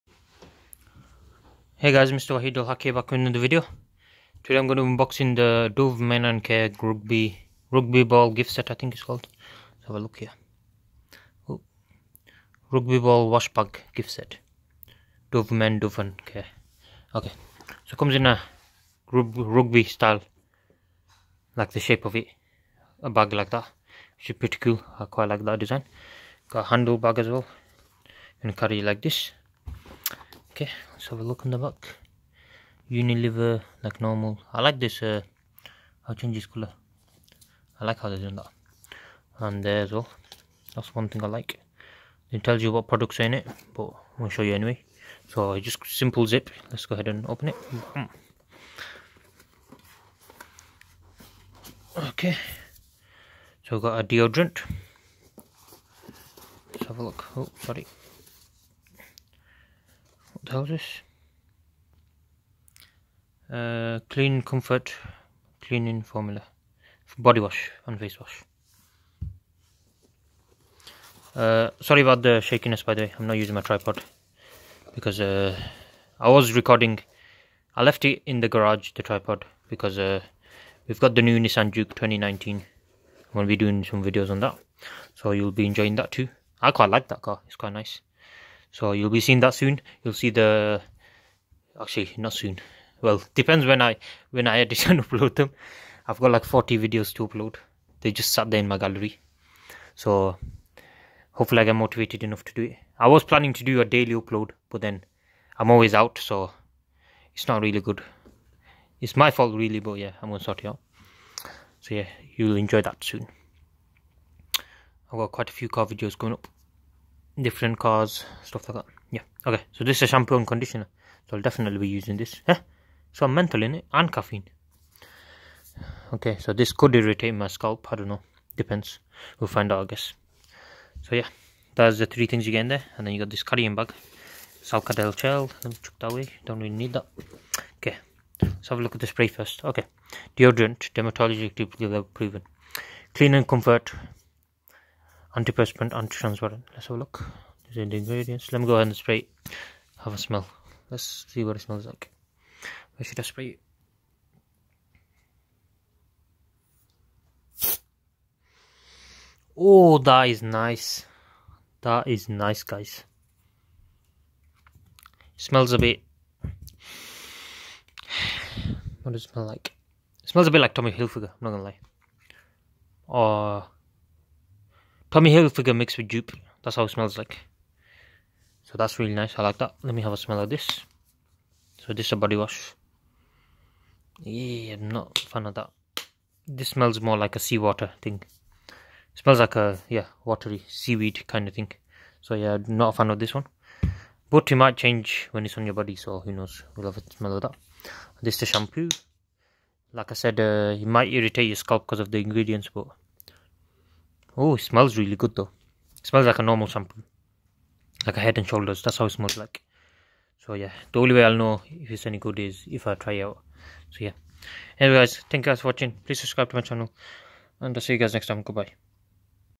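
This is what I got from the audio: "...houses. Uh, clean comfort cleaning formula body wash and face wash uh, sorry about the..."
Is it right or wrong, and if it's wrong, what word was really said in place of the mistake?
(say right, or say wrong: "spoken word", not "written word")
right.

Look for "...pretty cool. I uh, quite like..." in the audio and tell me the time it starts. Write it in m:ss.
0:24.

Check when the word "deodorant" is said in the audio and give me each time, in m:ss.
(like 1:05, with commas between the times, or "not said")
0:54, 2:20.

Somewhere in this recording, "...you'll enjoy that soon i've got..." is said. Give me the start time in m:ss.
1:52.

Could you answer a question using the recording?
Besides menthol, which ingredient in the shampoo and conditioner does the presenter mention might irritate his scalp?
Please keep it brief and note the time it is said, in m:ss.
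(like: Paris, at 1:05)
caffeine, at 2:04.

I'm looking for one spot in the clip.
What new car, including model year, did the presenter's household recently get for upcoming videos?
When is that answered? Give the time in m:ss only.
1:21.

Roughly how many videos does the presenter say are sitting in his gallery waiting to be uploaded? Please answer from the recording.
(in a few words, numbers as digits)
40.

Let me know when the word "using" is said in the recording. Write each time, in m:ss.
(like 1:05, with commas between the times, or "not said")
1:13, 2:01.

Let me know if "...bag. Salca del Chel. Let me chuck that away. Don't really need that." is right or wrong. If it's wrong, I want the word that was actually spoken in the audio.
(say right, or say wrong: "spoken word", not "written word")
right.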